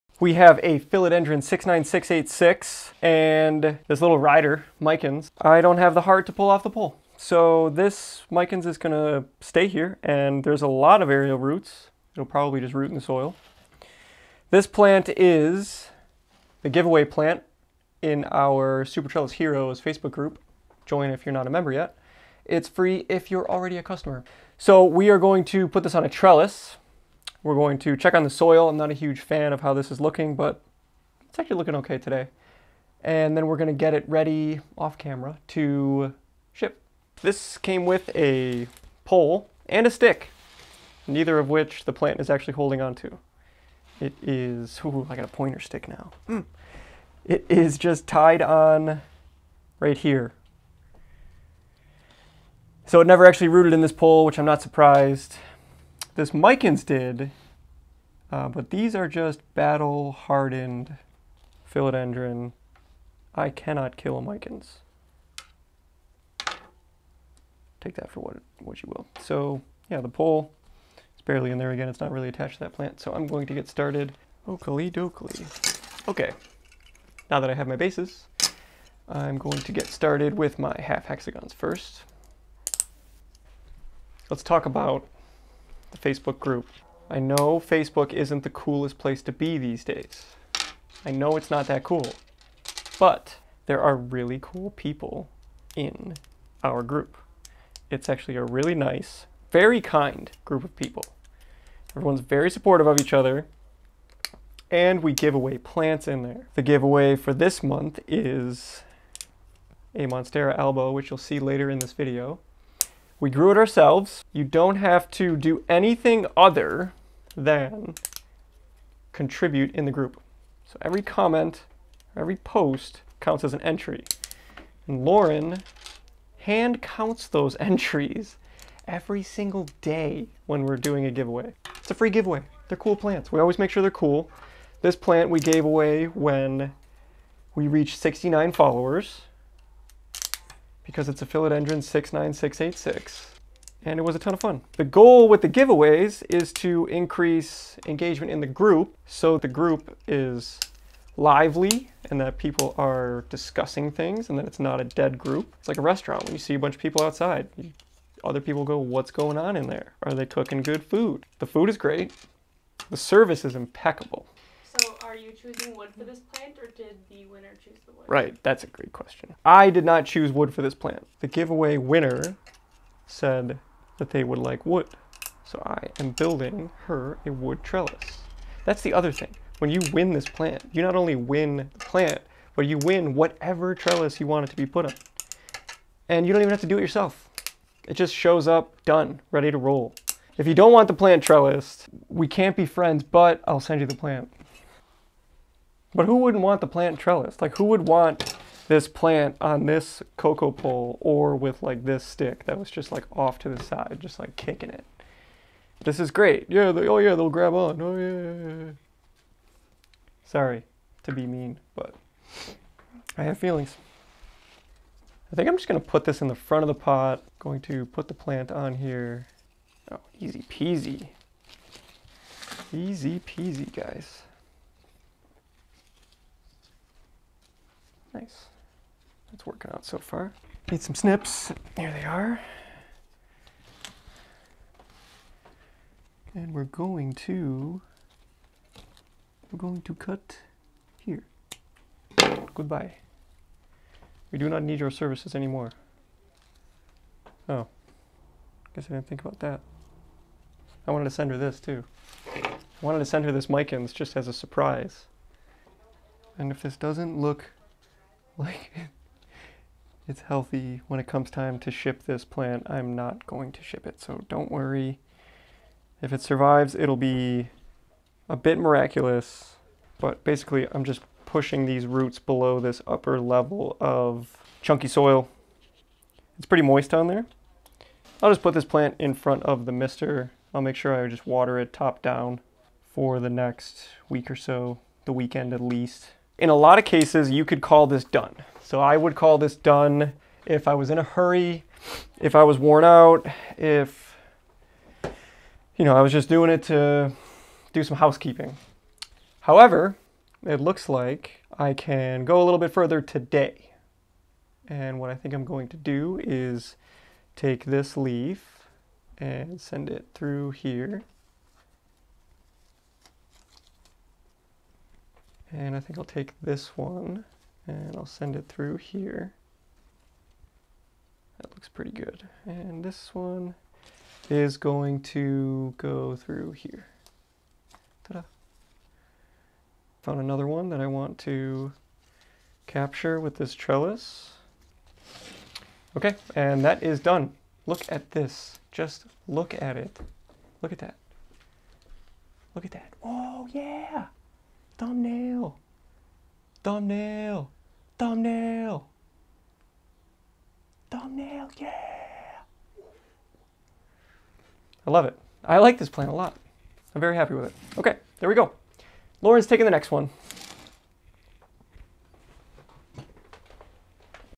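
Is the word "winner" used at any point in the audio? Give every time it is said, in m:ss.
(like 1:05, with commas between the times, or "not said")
2:47, 2:51.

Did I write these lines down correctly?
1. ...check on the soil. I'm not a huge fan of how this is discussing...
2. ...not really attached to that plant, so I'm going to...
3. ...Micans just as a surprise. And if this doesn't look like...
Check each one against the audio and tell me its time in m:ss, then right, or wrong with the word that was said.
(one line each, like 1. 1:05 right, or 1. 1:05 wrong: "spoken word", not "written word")
1. 0:27 wrong: "looking", not "discussing"
2. 1:12 right
3. 4:13 right.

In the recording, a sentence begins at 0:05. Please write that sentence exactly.
I don't have the heart to pull off the pole.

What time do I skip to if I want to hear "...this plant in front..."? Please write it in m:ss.
4:38.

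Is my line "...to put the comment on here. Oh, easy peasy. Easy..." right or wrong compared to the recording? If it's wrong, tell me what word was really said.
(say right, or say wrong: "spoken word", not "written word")
wrong: "plant", not "comment".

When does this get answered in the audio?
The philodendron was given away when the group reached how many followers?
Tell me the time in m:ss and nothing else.
2:17.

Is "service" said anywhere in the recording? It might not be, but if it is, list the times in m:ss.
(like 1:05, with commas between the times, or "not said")
2:42, 4:04.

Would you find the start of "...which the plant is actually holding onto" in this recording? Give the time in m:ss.
0:41.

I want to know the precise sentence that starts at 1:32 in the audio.
But there are really cool people in our group.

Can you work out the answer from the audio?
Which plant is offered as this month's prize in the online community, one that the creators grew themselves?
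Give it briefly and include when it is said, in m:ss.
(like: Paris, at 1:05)
Monstera albo, at 1:50.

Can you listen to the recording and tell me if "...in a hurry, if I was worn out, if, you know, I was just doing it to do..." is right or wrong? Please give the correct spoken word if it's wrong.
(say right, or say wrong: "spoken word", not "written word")
right.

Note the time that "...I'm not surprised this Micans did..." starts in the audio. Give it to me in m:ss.
0:54.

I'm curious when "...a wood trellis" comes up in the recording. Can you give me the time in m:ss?
2:57.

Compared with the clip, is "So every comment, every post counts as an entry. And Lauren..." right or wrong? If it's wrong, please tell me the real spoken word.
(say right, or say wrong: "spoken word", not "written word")
right.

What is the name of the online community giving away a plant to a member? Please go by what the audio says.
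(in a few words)
Super Trellis Heroes.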